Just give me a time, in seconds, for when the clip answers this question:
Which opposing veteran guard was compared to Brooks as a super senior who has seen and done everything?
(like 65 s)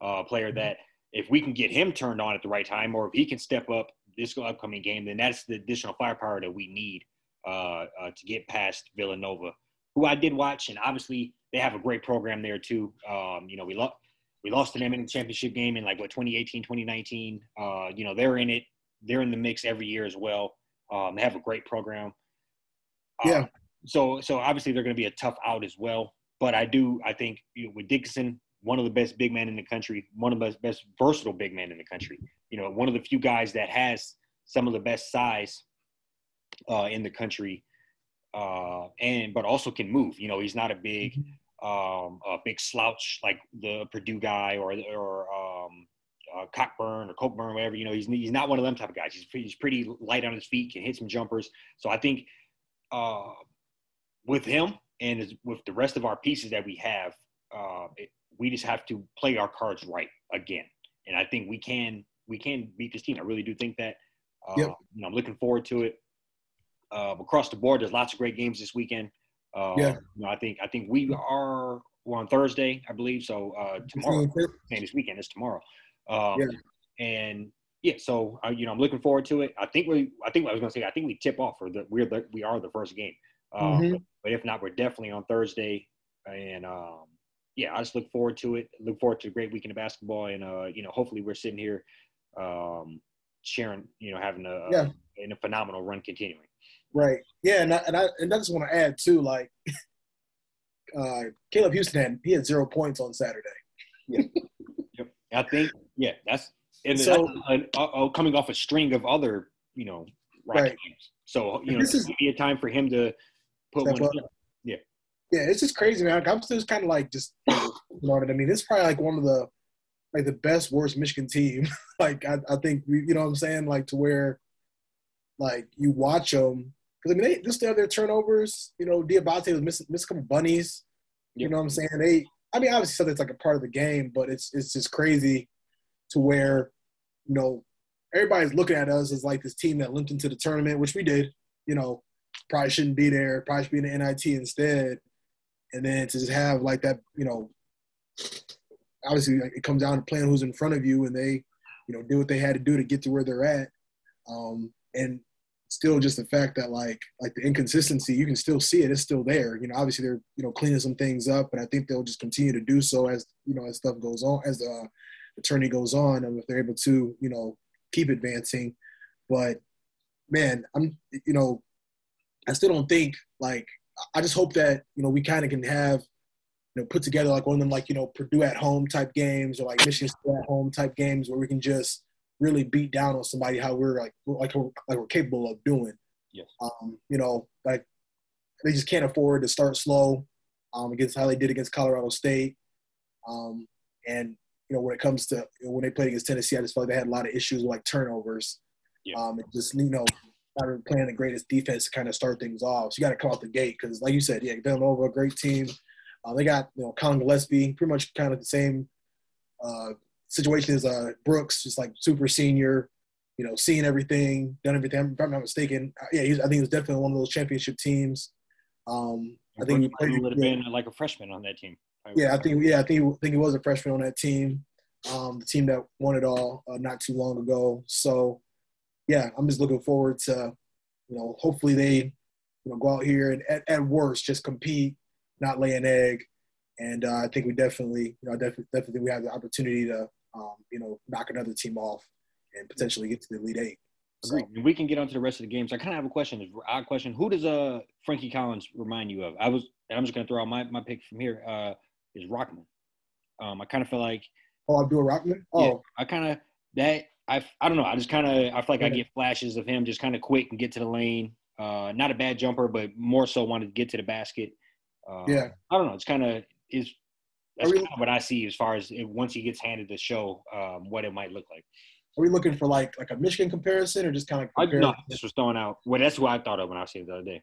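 206 s.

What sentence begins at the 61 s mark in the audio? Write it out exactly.
And I think we can we can beat this team.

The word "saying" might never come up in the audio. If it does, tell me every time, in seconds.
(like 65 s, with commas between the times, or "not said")
123 s, 131 s.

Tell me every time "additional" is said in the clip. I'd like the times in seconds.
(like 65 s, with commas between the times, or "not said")
5 s.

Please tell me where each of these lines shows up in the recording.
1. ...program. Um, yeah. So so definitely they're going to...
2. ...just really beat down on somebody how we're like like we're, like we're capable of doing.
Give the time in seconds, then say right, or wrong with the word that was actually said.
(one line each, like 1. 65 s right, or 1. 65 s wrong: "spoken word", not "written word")
1. 21 s wrong: "obviously", not "definitely"
2. 181 s right.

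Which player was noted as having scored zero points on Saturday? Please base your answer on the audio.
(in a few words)
Caleb Houston.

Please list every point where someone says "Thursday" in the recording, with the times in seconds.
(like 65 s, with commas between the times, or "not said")
72 s, 85 s.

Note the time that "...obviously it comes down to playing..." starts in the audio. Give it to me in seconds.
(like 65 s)
149 s.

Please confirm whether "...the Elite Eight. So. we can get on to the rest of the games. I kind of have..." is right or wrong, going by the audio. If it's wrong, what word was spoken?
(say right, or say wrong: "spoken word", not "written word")
right.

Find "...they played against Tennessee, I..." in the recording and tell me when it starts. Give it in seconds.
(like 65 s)
195 s.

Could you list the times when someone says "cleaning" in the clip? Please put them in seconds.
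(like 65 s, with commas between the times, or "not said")
160 s.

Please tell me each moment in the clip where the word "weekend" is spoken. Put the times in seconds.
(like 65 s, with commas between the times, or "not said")
68 s, 74 s, 89 s.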